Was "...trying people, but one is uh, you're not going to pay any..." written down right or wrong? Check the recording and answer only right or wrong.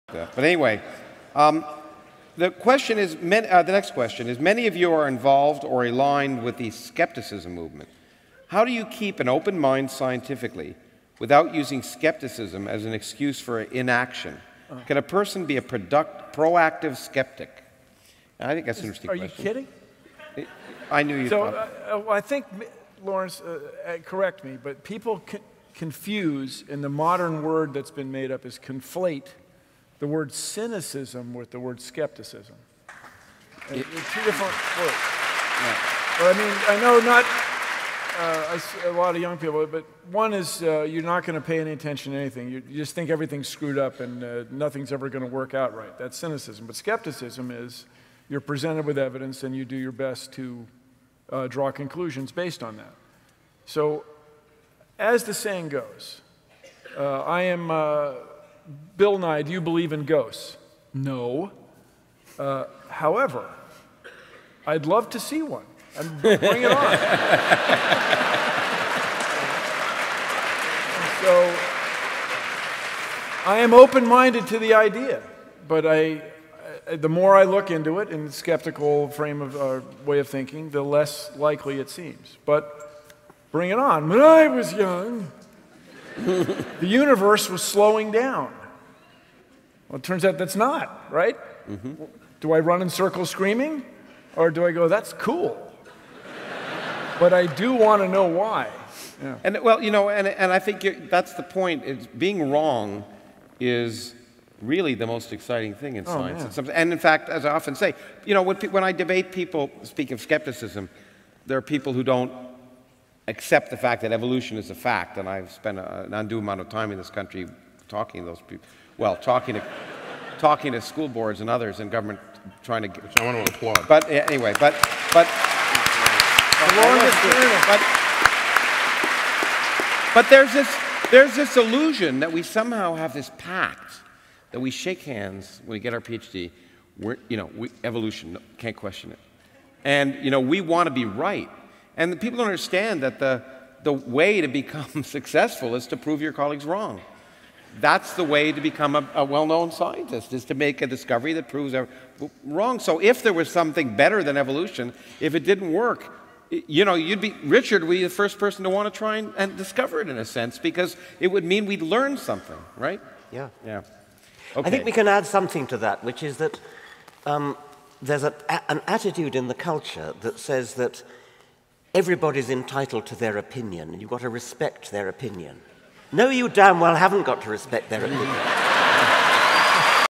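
wrong.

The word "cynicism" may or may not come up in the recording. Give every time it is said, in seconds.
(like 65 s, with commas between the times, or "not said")
30 s, 46 s.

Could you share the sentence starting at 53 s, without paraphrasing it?
So, as the saying goes, uh, I am uh, Bill Nye, do you believe in ghosts?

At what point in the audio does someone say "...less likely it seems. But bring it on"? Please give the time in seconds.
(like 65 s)
80 s.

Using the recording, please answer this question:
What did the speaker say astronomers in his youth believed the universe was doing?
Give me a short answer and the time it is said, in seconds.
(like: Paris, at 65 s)
slowing down, at 87 s.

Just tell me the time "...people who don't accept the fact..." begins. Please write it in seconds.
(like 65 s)
111 s.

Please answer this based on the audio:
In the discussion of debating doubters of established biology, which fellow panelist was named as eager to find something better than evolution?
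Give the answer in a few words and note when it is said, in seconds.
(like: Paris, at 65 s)
Richard, at 157 s.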